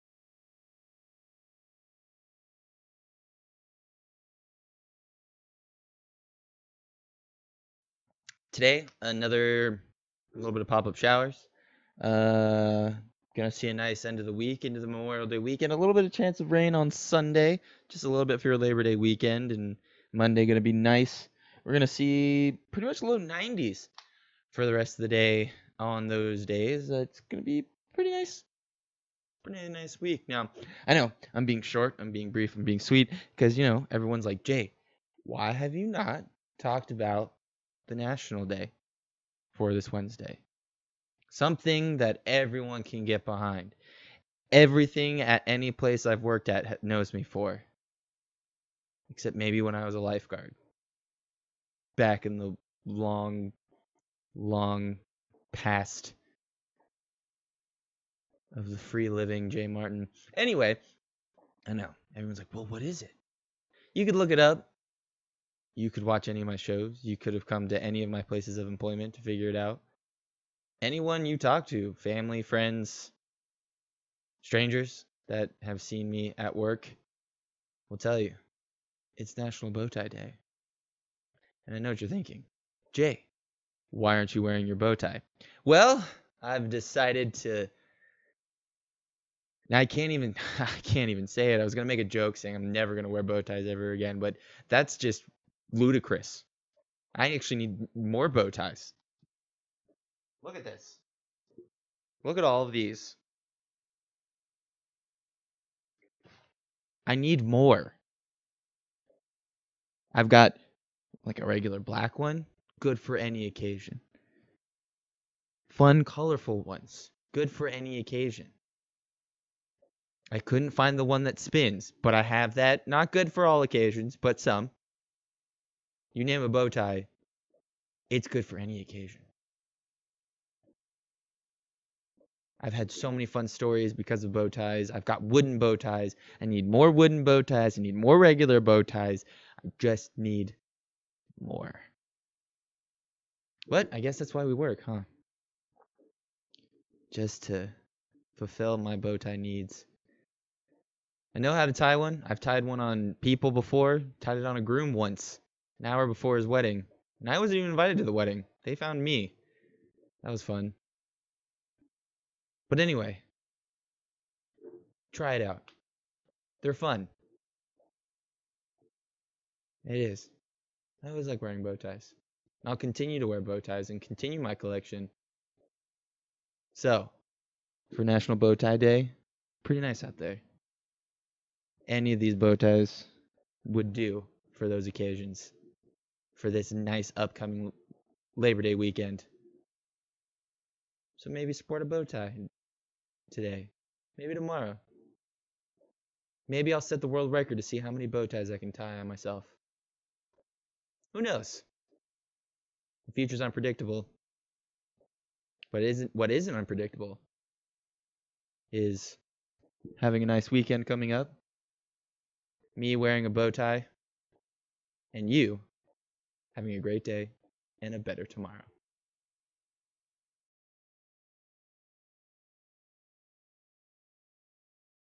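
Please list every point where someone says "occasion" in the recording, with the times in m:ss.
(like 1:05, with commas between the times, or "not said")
1:53, 1:57, 2:03, 2:08, 3:04.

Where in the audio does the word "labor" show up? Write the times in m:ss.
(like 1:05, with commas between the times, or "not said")
0:18, 3:08.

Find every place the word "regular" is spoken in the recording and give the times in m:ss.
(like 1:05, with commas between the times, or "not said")
1:51, 2:18.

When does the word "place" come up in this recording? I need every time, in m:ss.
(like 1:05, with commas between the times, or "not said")
0:45, 1:08.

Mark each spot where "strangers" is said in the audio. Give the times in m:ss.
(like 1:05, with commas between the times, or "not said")
1:14.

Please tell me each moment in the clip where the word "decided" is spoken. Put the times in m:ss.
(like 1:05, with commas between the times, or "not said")
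1:26.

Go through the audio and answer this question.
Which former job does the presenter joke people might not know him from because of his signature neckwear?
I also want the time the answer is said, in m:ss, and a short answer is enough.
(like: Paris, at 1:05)
lifeguard, at 0:49.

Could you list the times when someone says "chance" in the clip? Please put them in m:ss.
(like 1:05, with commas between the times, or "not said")
0:16.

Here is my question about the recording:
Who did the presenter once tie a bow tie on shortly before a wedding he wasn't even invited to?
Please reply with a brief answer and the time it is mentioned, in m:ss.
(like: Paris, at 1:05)
a groom, at 2:34.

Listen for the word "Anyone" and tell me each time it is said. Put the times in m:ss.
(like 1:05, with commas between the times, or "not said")
1:10.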